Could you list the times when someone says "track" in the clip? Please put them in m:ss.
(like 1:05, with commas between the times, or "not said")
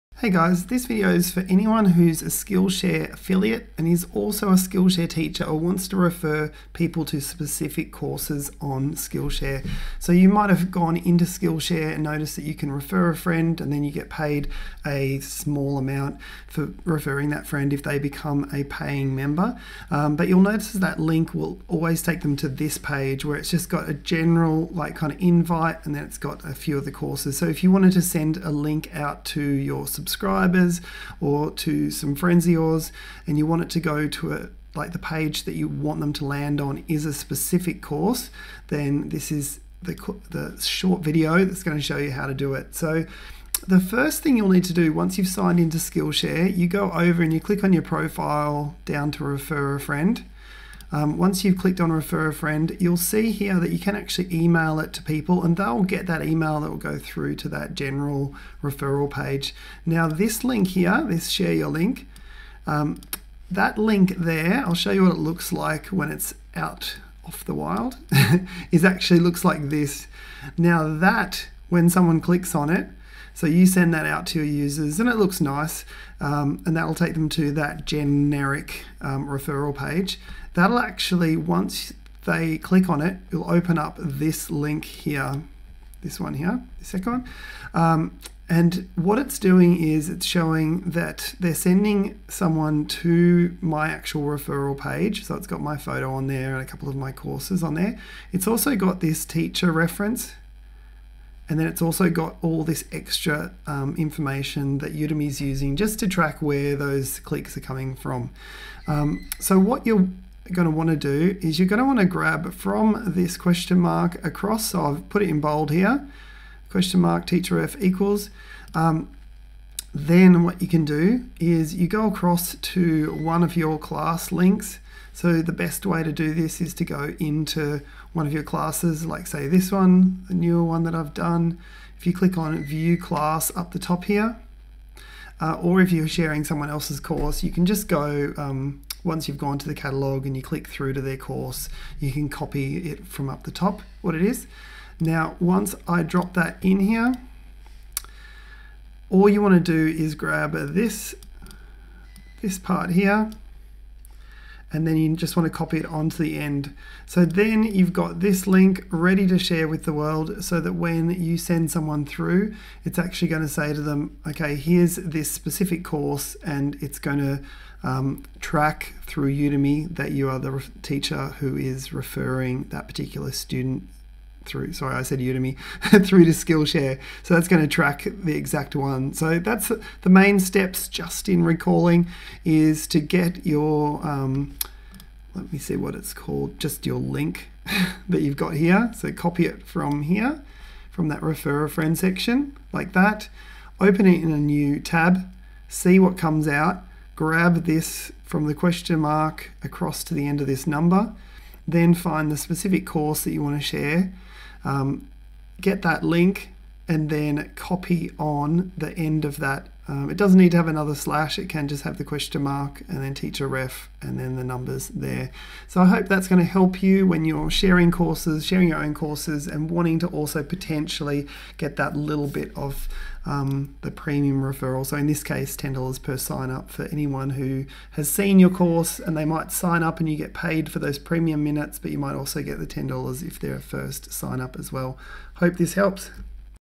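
1:46, 2:48, 2:57.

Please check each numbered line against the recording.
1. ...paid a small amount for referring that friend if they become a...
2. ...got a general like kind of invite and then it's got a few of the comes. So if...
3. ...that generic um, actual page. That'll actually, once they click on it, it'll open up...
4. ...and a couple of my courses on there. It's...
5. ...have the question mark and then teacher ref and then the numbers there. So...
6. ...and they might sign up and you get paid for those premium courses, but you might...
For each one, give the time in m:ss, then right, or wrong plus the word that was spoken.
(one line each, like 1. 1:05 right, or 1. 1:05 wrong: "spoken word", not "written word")
1. 0:14 right
2. 0:23 wrong: "courses", not "comes"
3. 1:17 wrong: "referral", not "actual"
4. 1:36 right
5. 3:31 right
6. 3:48 wrong: "minutes", not "courses".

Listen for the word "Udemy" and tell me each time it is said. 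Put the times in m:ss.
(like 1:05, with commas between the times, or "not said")
1:44, 2:49, 2:55.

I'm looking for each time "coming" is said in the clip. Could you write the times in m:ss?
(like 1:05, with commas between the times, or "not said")
1:47.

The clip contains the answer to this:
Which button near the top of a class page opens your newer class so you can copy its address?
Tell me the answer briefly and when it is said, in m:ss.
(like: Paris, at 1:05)
view class, at 2:12.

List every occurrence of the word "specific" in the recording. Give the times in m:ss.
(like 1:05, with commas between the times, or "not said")
0:07, 0:37, 2:45, 3:22.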